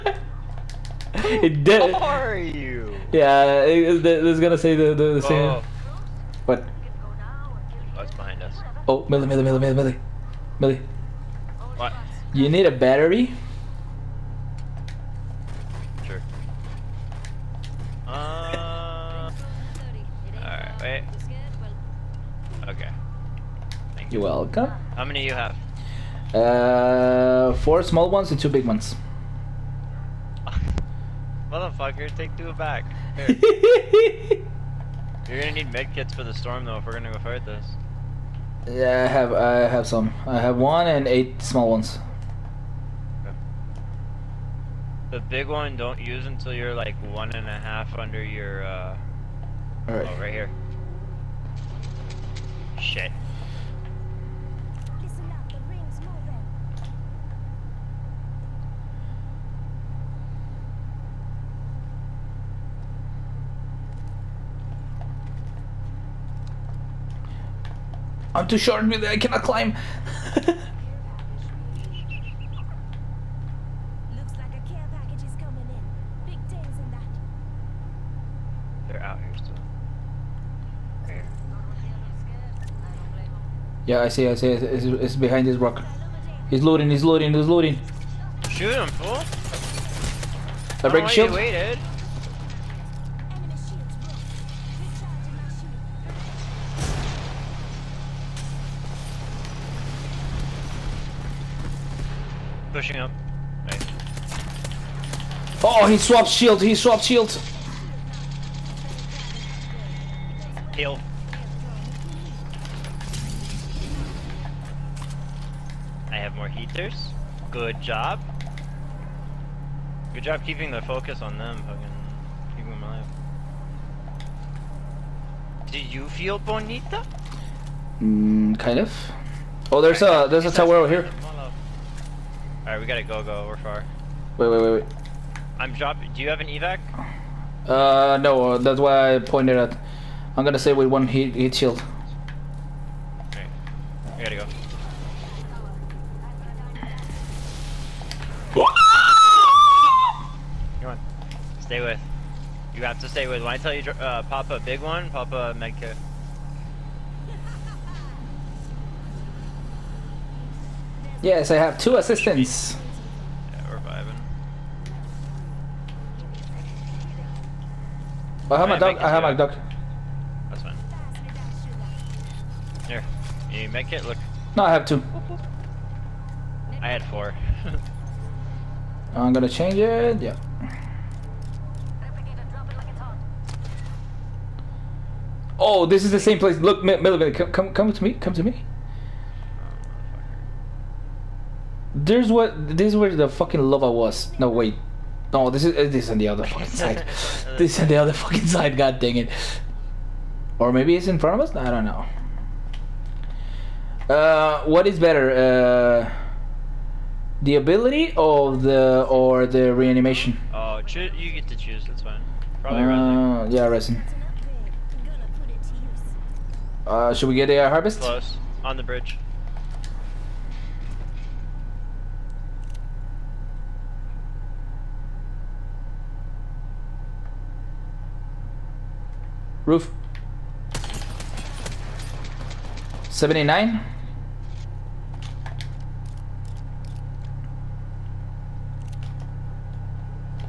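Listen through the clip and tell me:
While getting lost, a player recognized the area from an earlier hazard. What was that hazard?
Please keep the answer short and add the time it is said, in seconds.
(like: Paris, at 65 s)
Lava, at 193 s.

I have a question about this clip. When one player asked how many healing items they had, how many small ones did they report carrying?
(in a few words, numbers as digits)
4.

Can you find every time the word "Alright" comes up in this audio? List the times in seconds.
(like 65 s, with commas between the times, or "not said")
20 s, 132 s.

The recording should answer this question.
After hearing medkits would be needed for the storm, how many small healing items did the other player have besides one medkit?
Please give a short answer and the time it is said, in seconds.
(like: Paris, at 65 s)
8, at 41 s.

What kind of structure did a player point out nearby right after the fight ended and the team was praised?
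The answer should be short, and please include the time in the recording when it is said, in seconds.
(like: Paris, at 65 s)
A tower, at 130 s.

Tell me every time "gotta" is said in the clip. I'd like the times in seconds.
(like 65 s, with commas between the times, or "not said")
132 s, 144 s.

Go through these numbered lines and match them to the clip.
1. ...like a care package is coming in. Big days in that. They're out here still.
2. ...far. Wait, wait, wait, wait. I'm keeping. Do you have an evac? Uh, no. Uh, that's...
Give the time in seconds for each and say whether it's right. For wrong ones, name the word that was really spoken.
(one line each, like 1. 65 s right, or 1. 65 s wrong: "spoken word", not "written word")
1. 70 s right
2. 133 s wrong: "dropping", not "keeping".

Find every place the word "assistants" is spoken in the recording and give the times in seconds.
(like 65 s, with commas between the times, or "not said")
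161 s.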